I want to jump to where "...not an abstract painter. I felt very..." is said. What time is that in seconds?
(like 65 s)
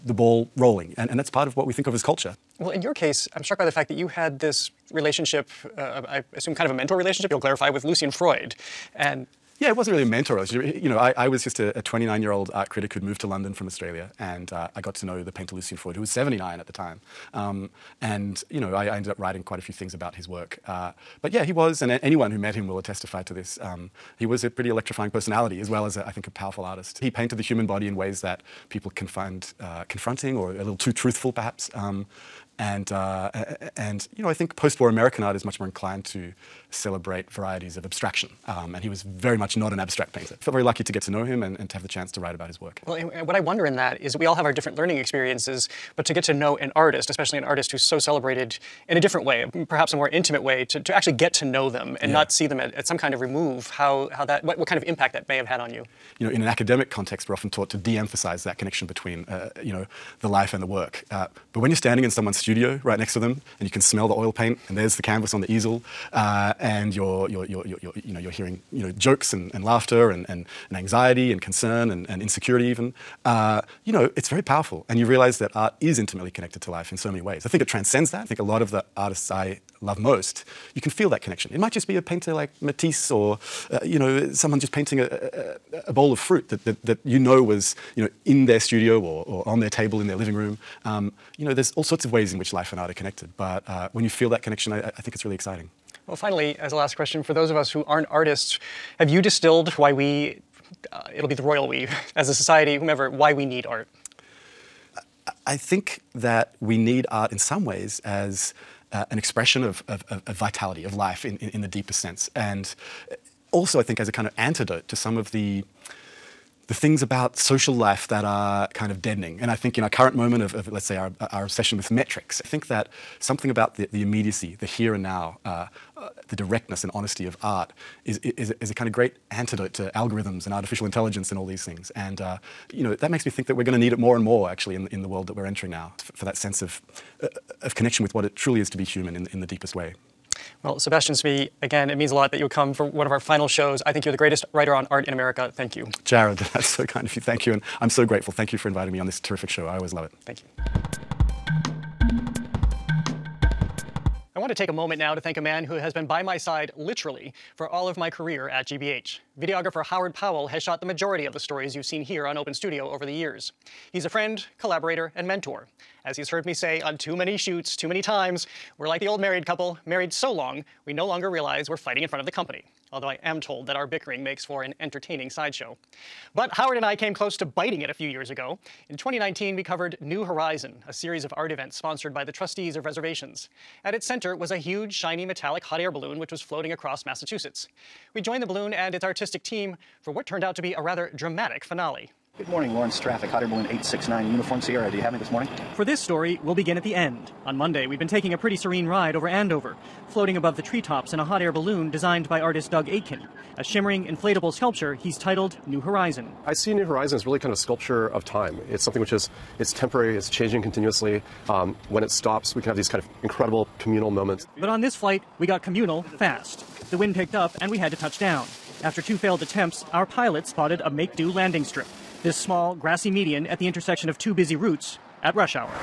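39 s.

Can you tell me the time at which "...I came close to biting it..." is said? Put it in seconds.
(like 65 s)
176 s.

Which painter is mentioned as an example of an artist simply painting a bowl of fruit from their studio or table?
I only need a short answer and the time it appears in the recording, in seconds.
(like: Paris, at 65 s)
Matisse, at 82 s.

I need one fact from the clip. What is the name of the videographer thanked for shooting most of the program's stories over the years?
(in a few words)
Howard Powell.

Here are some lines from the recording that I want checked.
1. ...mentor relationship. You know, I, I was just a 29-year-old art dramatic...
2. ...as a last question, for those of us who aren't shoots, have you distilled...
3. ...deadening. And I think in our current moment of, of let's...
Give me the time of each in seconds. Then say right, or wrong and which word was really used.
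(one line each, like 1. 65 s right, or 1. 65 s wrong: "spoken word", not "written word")
1. 10 s wrong: "critic", not "dramatic"
2. 96 s wrong: "artists", not "shoots"
3. 119 s right.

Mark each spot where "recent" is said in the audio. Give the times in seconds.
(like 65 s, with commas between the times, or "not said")
not said.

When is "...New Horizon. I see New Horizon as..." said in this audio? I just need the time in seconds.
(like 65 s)
205 s.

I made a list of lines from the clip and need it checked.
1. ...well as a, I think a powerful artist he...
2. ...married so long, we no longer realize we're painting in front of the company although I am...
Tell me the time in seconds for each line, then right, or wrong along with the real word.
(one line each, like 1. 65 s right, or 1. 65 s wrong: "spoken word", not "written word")
1. 25 s right
2. 169 s wrong: "fighting", not "painting".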